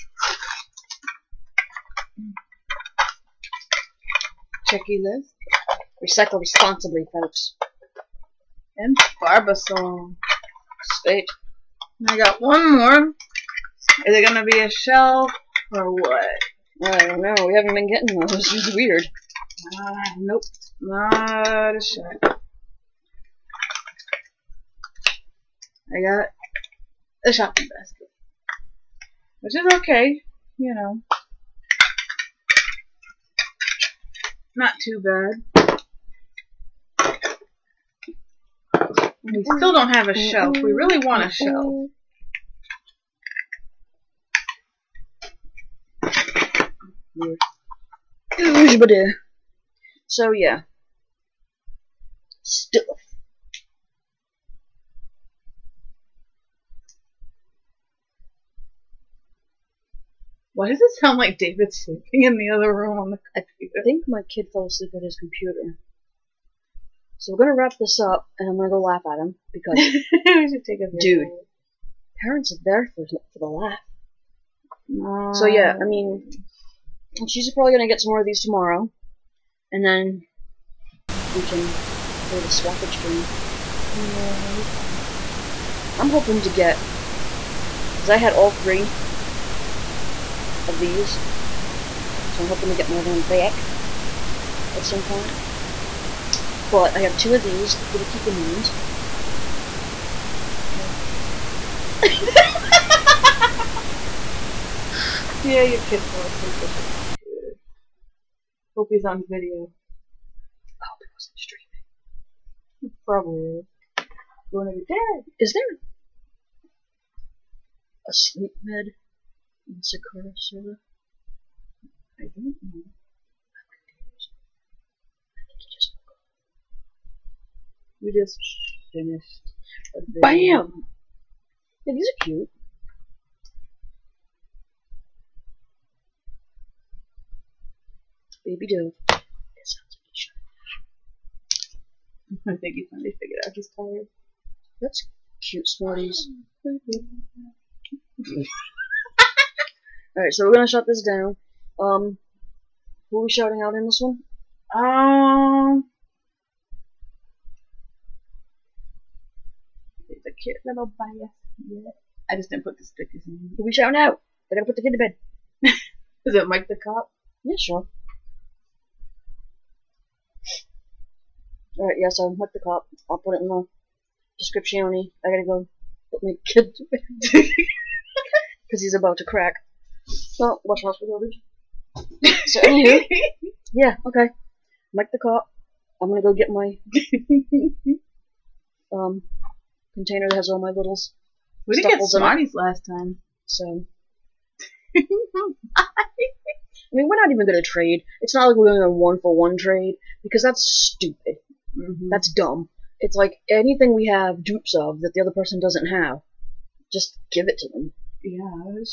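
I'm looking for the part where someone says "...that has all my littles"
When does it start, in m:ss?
3:10.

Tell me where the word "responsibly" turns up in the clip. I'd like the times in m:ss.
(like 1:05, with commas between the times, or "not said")
0:06.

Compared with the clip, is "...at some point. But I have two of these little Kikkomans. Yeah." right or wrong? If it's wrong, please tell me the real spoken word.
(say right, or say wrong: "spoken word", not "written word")
right.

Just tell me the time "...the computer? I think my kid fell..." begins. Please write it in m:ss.
1:03.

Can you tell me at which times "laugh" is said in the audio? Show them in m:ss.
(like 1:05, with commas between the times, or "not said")
1:08, 1:13.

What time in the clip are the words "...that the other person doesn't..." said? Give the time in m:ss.
3:25.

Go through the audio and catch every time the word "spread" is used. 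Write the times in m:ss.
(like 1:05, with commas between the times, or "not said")
not said.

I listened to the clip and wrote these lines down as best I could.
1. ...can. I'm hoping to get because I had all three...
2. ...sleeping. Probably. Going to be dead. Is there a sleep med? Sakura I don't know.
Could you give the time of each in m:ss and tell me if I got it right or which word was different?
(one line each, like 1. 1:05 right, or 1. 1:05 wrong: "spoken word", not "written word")
1. 1:24 right
2. 1:51 wrong: "streaming", not "sleeping".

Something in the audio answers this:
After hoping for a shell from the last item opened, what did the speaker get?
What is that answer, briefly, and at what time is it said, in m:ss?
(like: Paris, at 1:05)
Shopping basket, at 0:27.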